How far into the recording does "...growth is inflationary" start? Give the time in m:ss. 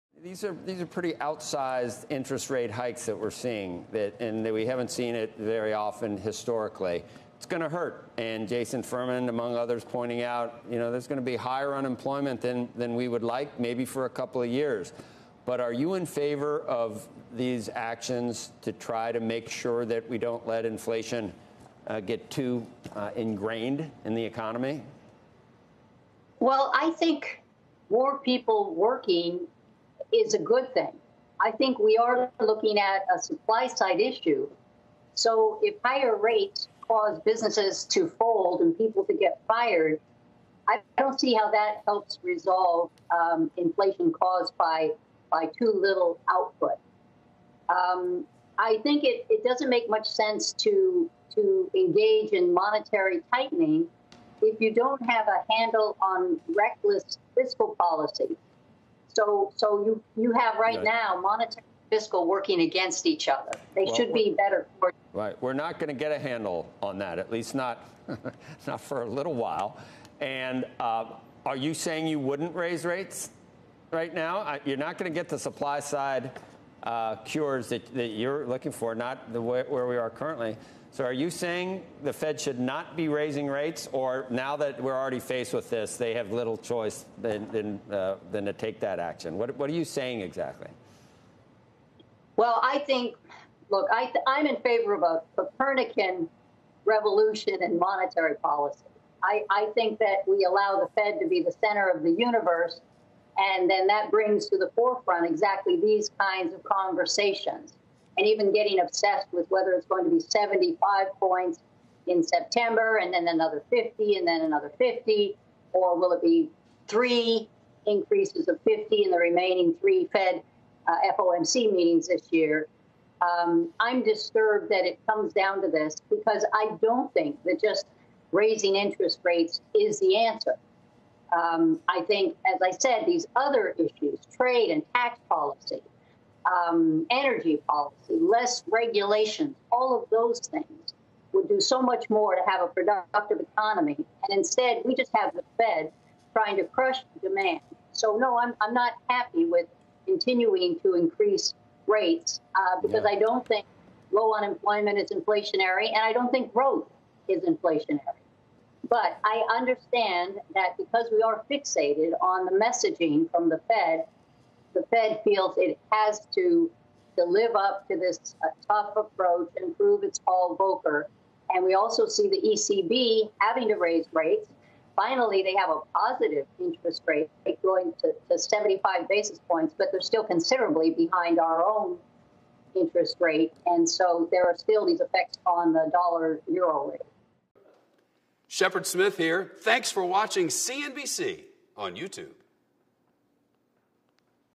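2:36.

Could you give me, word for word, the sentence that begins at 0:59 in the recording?
So, so you, you have right, right.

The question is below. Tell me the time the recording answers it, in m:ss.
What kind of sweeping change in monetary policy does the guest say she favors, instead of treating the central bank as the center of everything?
1:35.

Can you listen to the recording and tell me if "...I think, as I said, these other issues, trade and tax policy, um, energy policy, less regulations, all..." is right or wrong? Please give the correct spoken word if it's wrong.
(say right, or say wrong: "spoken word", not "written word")
right.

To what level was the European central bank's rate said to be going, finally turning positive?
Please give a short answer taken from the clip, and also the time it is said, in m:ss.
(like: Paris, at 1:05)
75 basis points, at 2:58.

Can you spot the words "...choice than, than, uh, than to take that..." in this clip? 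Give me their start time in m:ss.
1:26.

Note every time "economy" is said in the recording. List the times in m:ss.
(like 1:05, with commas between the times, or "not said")
0:24, 2:23.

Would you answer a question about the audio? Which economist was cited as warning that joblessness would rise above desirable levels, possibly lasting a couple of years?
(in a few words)
Jason Furman.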